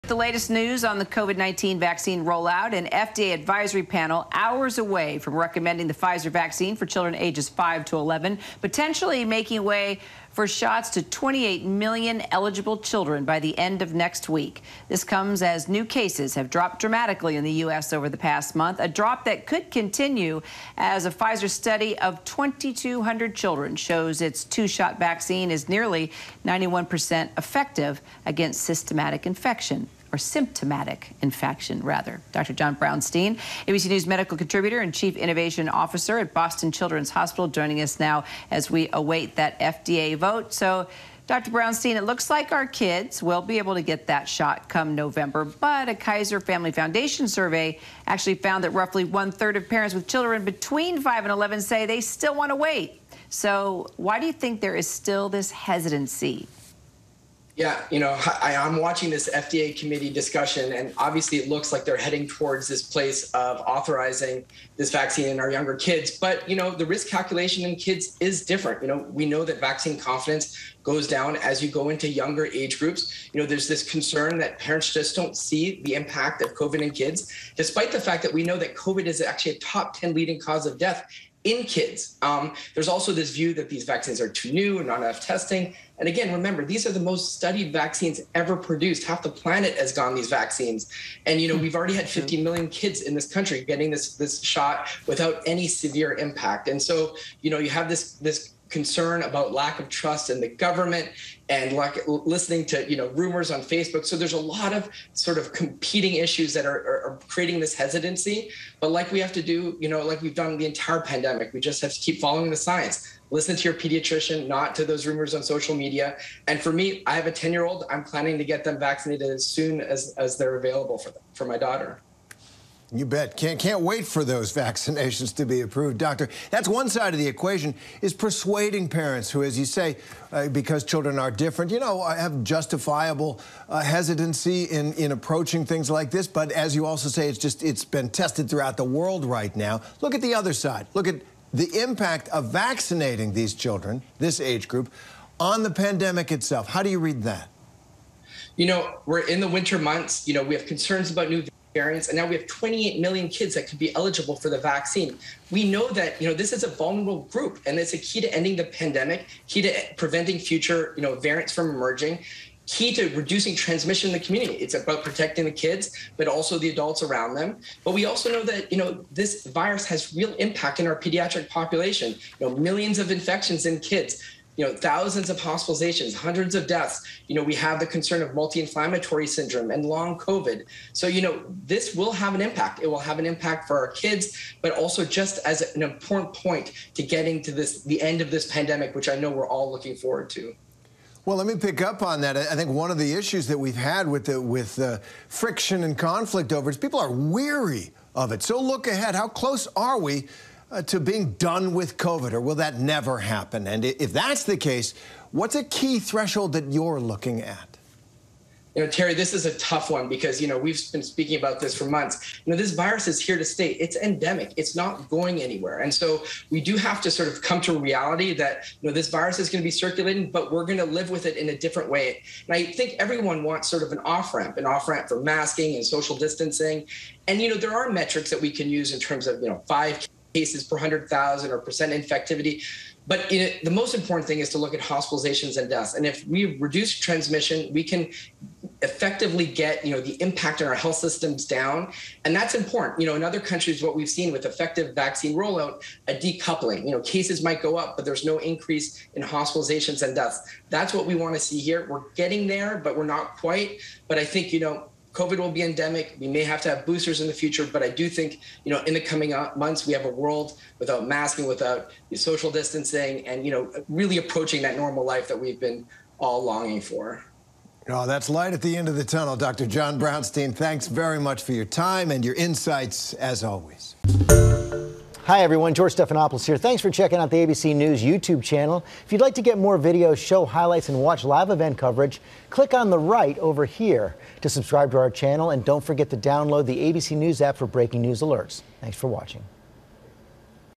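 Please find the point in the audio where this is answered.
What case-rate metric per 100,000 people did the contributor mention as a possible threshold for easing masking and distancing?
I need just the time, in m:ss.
3:49.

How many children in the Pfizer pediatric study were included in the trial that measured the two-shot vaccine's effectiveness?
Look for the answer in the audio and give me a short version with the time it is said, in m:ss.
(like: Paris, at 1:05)
2,200, at 0:22.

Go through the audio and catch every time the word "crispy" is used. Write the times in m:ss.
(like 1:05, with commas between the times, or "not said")
not said.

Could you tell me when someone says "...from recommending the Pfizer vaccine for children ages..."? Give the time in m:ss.
0:05.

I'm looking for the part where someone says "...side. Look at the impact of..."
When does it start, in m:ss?
2:20.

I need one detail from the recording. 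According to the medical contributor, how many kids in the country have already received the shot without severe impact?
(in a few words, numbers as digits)
50 million.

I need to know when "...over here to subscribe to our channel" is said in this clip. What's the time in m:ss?
4:43.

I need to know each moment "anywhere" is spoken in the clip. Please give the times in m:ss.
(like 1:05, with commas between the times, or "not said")
3:35.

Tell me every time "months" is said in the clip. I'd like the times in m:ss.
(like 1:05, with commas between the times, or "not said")
0:18, 2:29, 3:31, 4:19.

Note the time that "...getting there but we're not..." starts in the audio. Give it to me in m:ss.
4:12.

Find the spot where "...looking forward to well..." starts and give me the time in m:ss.
3:09.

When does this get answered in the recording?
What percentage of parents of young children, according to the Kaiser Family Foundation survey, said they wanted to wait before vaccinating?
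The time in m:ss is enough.
0:49.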